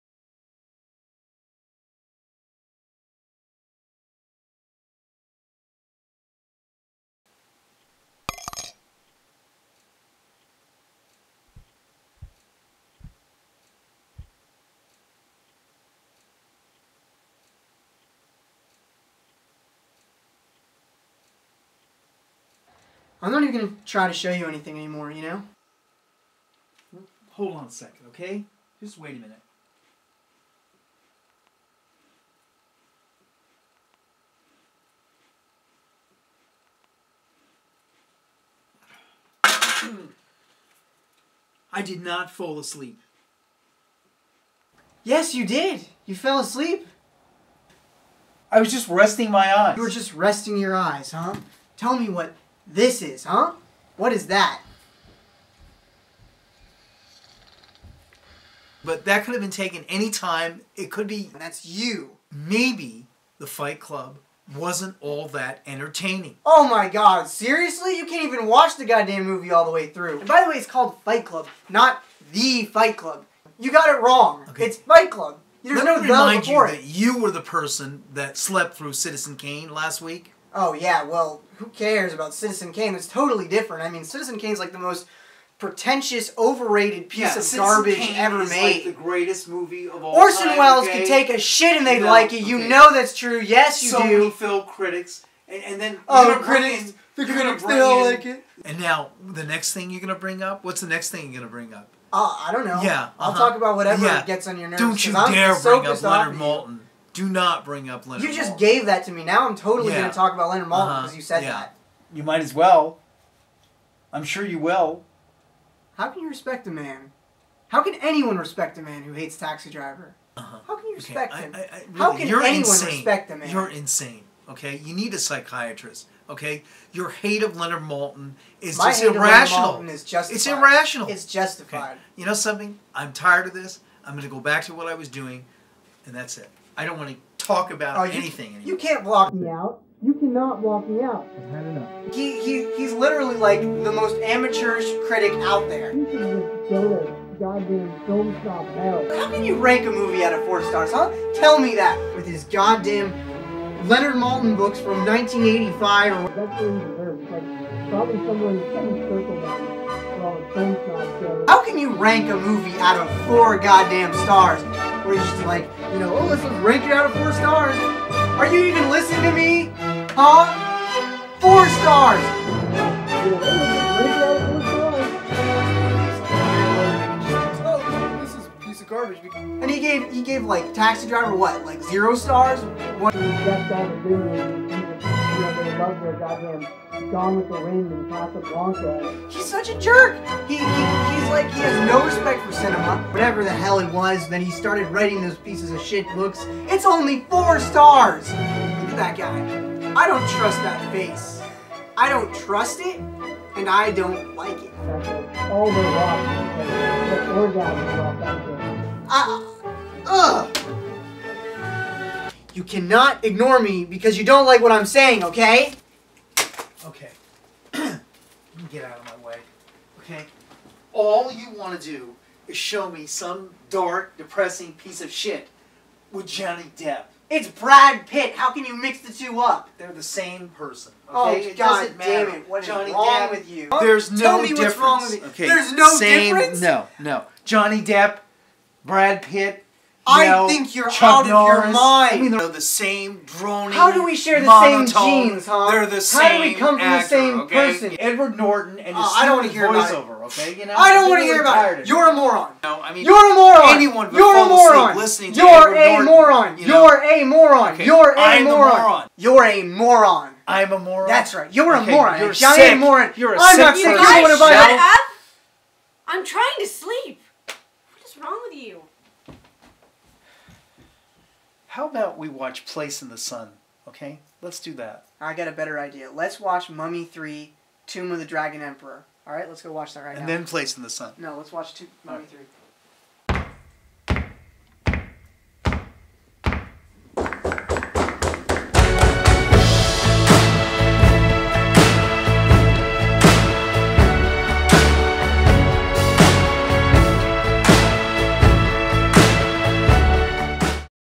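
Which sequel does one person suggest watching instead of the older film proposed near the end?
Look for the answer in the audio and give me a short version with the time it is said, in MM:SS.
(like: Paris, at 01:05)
Mummy 3: Tomb of the Dragon Emperor, at 04:36.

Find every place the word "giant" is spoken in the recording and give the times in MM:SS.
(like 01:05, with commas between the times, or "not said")
04:22.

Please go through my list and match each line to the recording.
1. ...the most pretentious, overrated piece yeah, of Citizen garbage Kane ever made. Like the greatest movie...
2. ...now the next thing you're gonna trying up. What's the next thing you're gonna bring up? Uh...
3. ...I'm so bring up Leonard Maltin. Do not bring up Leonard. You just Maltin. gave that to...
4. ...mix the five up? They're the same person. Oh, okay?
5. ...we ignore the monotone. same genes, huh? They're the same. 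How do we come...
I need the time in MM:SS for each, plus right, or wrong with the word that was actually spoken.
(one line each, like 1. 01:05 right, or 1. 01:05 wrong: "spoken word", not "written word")
1. 01:24 right
2. 01:38 wrong: "bring", not "trying"
3. 01:45 right
4. 03:48 wrong: "two", not "five"
5. 04:04 wrong: "share", not "ignore".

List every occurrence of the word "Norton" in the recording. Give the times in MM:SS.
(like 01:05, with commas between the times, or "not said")
04:08, 04:16.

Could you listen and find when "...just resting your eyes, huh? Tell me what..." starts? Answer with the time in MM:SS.
00:49.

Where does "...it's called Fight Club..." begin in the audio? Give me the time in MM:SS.
01:10.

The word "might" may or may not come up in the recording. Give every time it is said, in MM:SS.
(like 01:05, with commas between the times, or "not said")
01:52.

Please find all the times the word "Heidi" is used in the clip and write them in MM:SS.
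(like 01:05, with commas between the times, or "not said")
not said.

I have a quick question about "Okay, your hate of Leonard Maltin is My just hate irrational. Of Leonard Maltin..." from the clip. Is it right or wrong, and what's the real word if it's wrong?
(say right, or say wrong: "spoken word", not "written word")
right.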